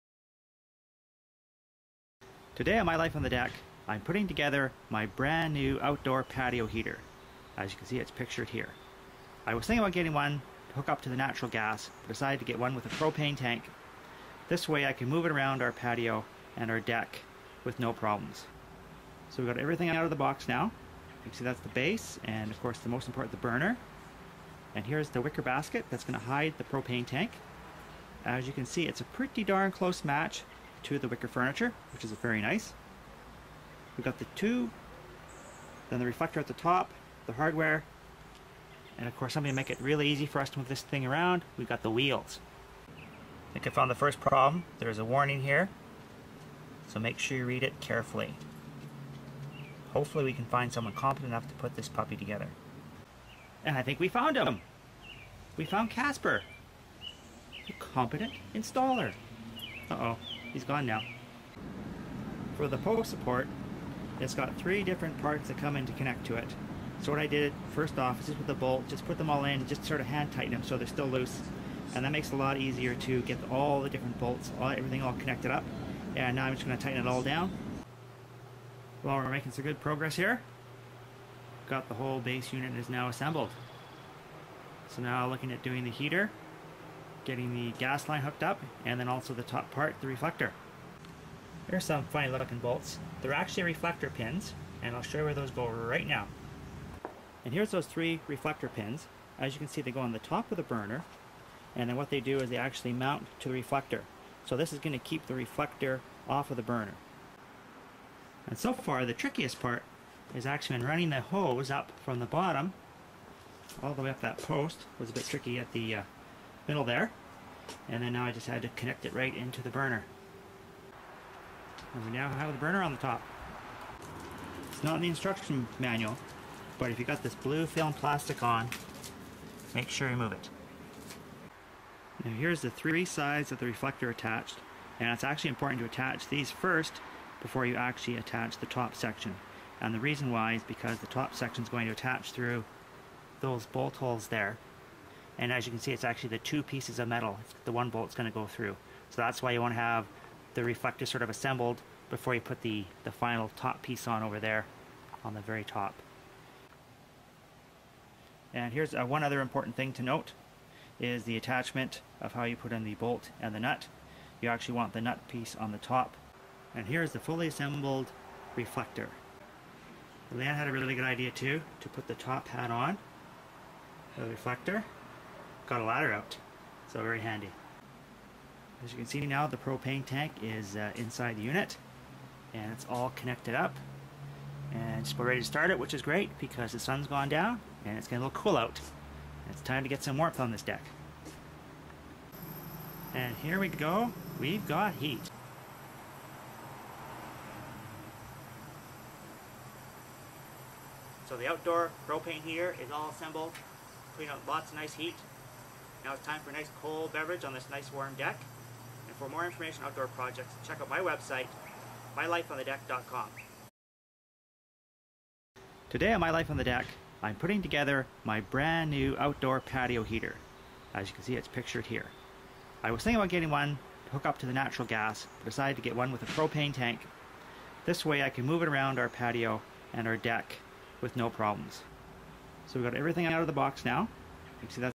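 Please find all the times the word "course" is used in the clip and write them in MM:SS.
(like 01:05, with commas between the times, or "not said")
00:22, 00:39.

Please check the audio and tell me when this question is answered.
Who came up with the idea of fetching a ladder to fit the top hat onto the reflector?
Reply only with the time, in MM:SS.
02:50.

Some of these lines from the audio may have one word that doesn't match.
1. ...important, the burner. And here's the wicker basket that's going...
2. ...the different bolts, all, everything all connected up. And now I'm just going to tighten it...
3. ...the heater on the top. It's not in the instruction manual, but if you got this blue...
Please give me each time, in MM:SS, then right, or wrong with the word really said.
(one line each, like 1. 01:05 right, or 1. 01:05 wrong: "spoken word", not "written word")
1. 00:23 right
2. 01:13 right
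3. 02:02 wrong: "burner", not "heater".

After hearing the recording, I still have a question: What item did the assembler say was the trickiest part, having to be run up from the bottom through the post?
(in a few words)
The hose.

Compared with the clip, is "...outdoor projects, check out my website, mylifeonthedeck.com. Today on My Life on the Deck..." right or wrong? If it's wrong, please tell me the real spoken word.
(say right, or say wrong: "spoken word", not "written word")
right.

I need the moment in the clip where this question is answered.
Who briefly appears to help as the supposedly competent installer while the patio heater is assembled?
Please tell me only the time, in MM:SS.
00:55.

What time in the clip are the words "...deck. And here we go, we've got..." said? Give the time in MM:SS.
03:10.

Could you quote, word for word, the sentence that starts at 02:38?
And here's uh, one other important thing to note is the attachment of how you put in the bolt and the nut.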